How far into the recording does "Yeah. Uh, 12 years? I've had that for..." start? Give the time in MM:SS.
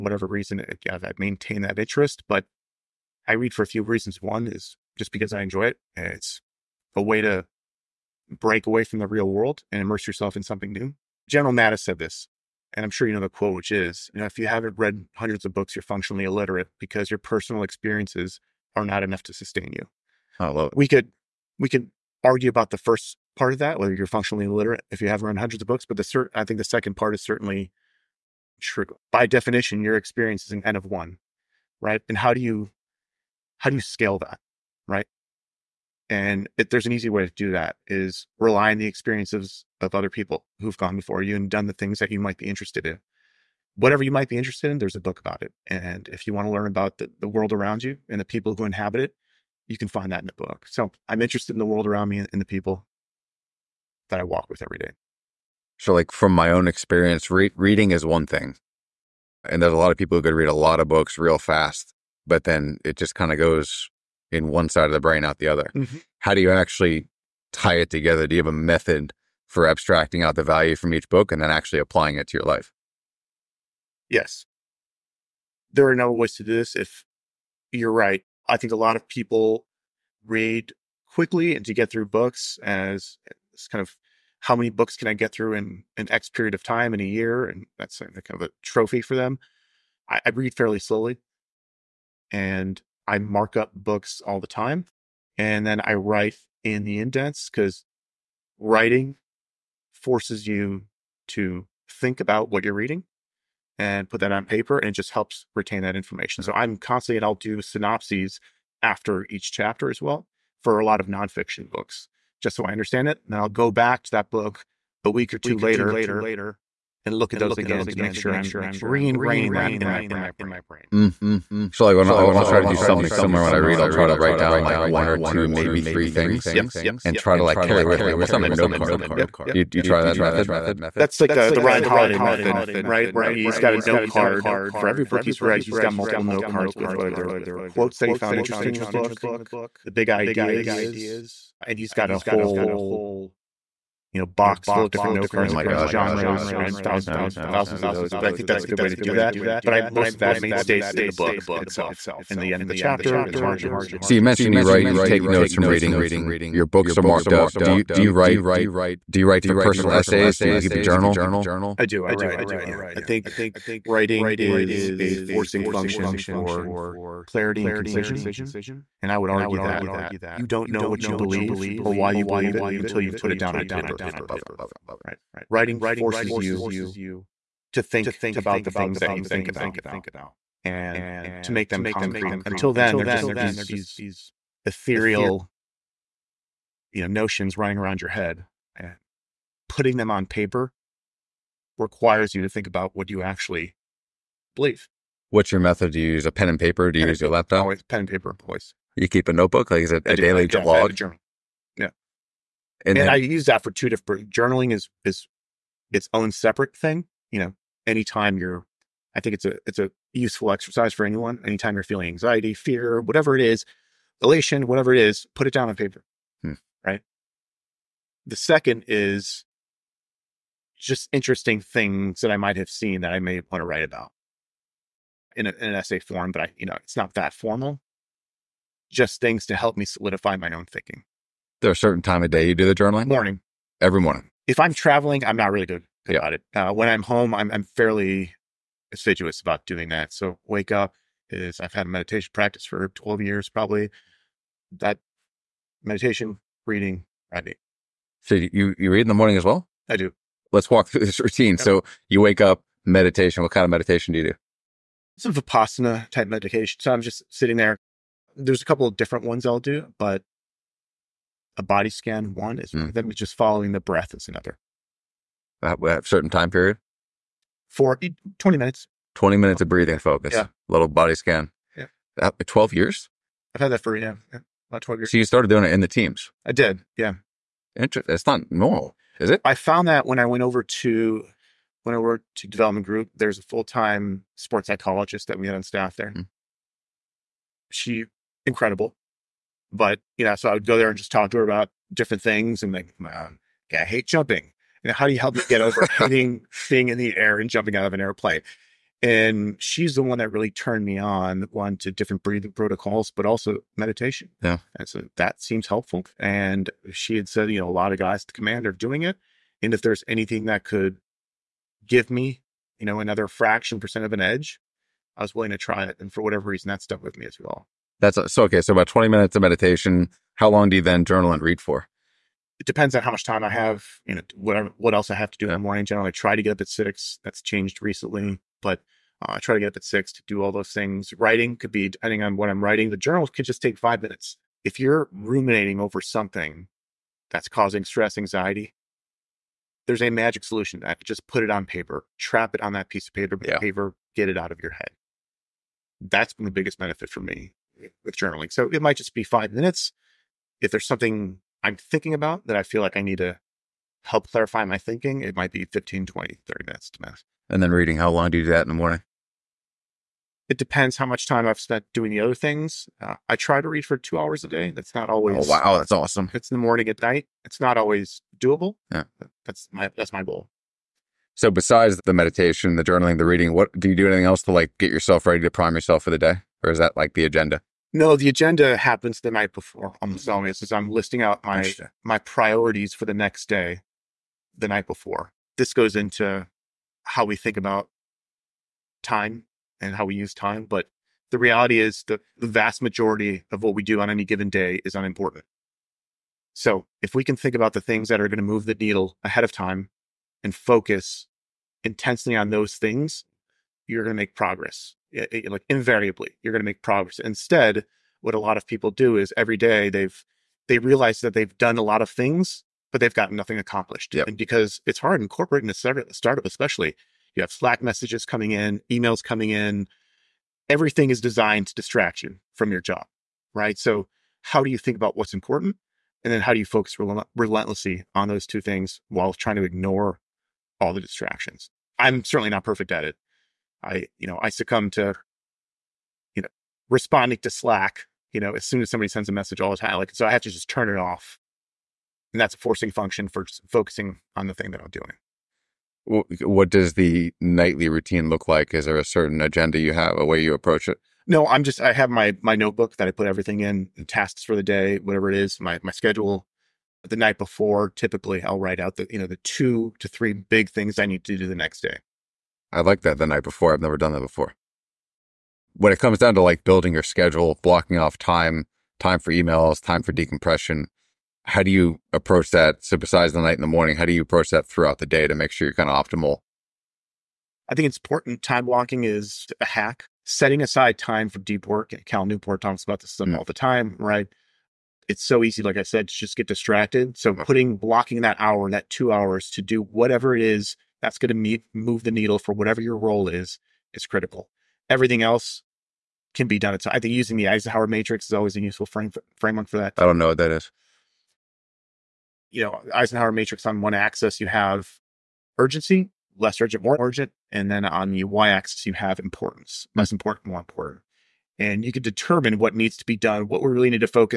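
04:31.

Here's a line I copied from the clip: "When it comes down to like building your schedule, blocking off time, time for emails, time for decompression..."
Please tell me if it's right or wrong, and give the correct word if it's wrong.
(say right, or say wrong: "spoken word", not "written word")
right.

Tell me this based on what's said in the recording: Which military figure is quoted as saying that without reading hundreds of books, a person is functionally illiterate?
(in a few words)
General Mattis.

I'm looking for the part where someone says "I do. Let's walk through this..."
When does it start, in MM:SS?
04:09.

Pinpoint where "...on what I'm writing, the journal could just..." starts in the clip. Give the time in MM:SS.
05:32.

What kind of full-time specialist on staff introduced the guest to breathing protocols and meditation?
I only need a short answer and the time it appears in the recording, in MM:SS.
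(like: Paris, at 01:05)
sports psychologist, at 04:44.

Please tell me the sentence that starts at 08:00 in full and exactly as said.
Setting aside time for deep work.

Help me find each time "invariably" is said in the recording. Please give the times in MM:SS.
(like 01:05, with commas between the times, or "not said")
06:45.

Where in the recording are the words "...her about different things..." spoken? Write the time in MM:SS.
04:51.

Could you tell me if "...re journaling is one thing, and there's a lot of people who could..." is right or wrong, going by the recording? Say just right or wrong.
wrong.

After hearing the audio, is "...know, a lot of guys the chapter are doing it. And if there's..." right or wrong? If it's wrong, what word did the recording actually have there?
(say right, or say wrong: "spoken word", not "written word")
wrong: "commander", not "chapter".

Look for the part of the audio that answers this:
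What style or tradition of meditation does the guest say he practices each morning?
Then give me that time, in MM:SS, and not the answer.
04:15.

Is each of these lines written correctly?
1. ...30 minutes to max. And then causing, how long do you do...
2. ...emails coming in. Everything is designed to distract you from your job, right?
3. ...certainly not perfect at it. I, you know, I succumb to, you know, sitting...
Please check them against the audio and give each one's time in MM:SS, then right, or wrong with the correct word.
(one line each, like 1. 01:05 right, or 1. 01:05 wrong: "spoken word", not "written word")
1. 05:56 wrong: "reading", not "causing"
2. 06:58 right
3. 07:12 wrong: "responding", not "sitting".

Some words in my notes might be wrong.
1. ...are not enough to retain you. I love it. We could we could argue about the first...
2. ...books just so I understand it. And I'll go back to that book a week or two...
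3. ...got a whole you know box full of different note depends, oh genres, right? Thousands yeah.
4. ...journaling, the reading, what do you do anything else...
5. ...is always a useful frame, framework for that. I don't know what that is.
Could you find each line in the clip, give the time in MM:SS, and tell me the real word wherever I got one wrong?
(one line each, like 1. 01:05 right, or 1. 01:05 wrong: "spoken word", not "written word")
1. 00:18 wrong: "sustain", not "retain"
2. 01:51 right
3. 02:21 wrong: "cards", not "depends"
4. 06:12 right
5. 08:18 right.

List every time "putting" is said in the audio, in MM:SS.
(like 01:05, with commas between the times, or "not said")
03:09, 08:07.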